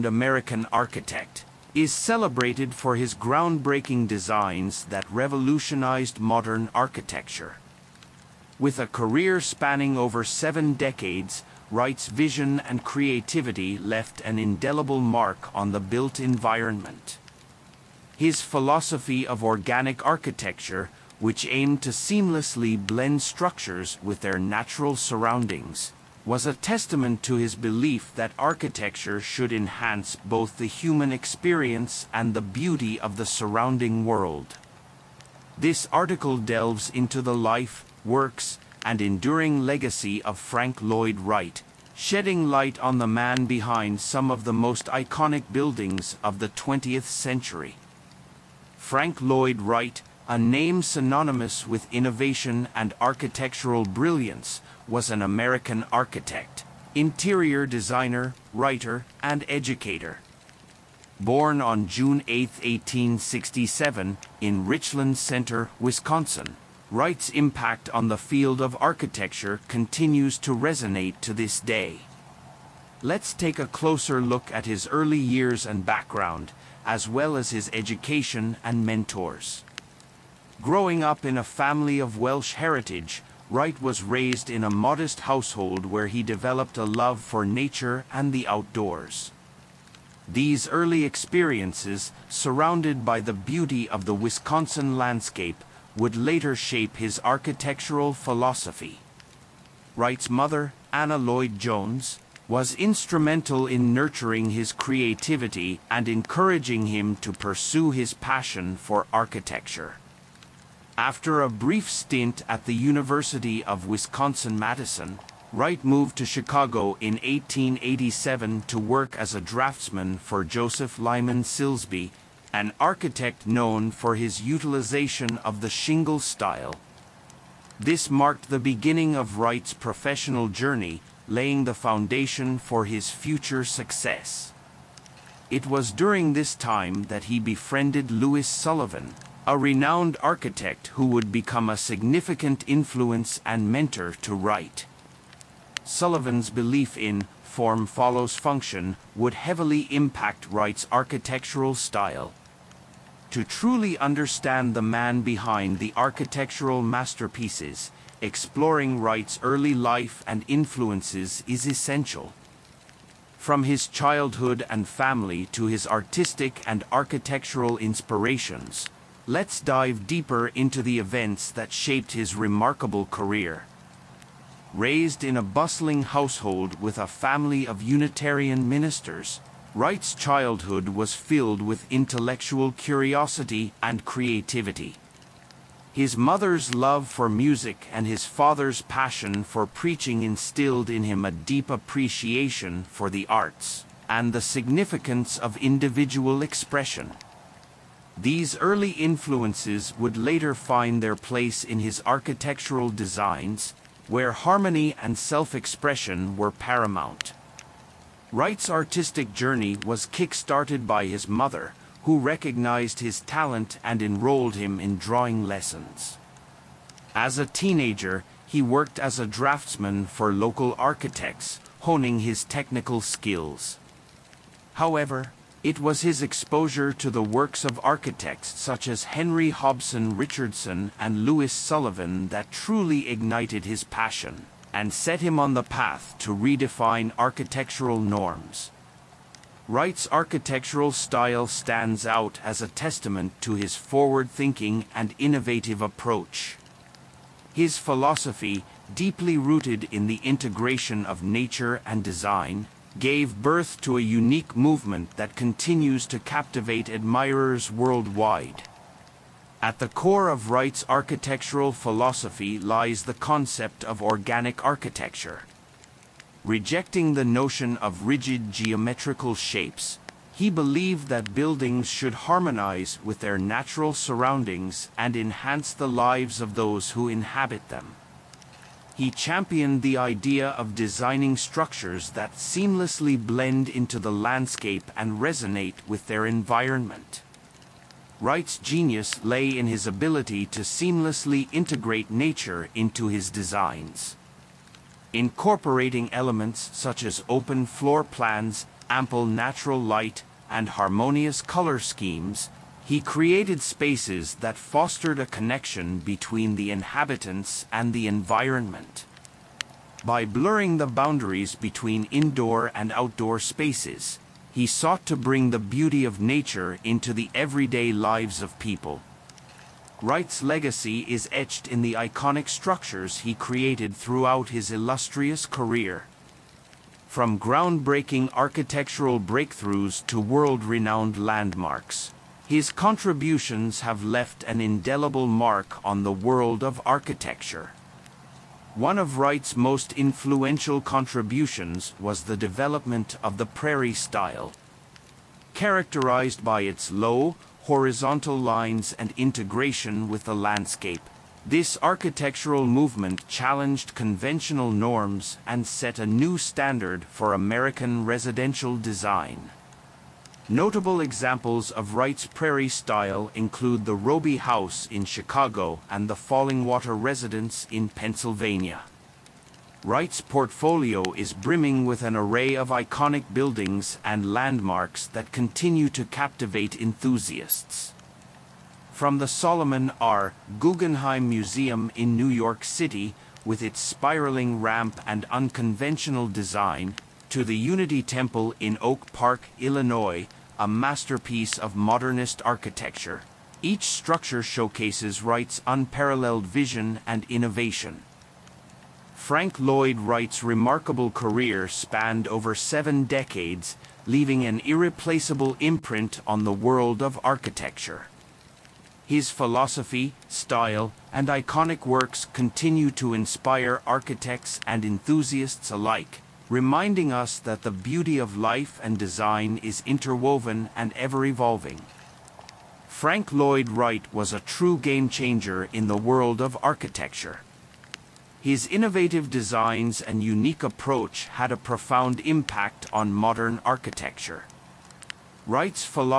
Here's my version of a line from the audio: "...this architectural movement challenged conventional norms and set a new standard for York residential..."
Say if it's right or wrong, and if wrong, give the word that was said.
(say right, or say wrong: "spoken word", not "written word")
wrong: "American", not "York".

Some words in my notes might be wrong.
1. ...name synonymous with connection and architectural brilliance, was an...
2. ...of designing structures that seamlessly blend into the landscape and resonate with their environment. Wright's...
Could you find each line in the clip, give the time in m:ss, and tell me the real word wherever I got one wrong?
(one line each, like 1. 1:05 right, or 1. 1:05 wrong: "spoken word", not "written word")
1. 0:50 wrong: "innovation", not "connection"
2. 4:40 right.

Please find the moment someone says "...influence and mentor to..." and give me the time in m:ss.
2:22.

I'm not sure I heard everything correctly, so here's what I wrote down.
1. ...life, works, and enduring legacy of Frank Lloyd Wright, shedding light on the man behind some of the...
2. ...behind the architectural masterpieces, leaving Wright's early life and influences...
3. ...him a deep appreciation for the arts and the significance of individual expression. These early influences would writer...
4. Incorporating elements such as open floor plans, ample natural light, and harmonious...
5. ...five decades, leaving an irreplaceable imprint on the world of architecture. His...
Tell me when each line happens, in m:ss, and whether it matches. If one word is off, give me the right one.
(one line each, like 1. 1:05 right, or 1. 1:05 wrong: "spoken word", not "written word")
1. 0:37 right
2. 2:35 wrong: "exploring", not "leaving"
3. 3:11 wrong: "later", not "writer"
4. 4:55 right
5. 6:42 wrong: "seven", not "five".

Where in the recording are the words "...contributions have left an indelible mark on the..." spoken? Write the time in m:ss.
5:32.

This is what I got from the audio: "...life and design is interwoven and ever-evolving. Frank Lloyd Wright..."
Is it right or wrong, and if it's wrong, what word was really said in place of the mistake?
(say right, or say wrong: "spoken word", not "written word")
right.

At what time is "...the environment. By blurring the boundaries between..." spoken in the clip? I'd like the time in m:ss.
5:07.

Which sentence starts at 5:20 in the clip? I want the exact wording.
Wright's legacy is etched in the iconic structures he created throughout his illustrious career.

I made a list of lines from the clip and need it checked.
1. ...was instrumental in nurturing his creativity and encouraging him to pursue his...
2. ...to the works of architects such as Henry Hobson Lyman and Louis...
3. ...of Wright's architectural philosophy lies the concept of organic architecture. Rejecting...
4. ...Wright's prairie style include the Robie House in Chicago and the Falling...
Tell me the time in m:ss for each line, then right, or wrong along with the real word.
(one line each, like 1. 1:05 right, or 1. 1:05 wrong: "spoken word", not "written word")
1. 1:42 right
2. 3:46 wrong: "Richardson", not "Lyman"
3. 4:20 right
4. 6:01 right.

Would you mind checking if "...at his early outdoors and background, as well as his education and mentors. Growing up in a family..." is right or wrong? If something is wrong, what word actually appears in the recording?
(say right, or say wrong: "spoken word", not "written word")
wrong: "years", not "outdoors".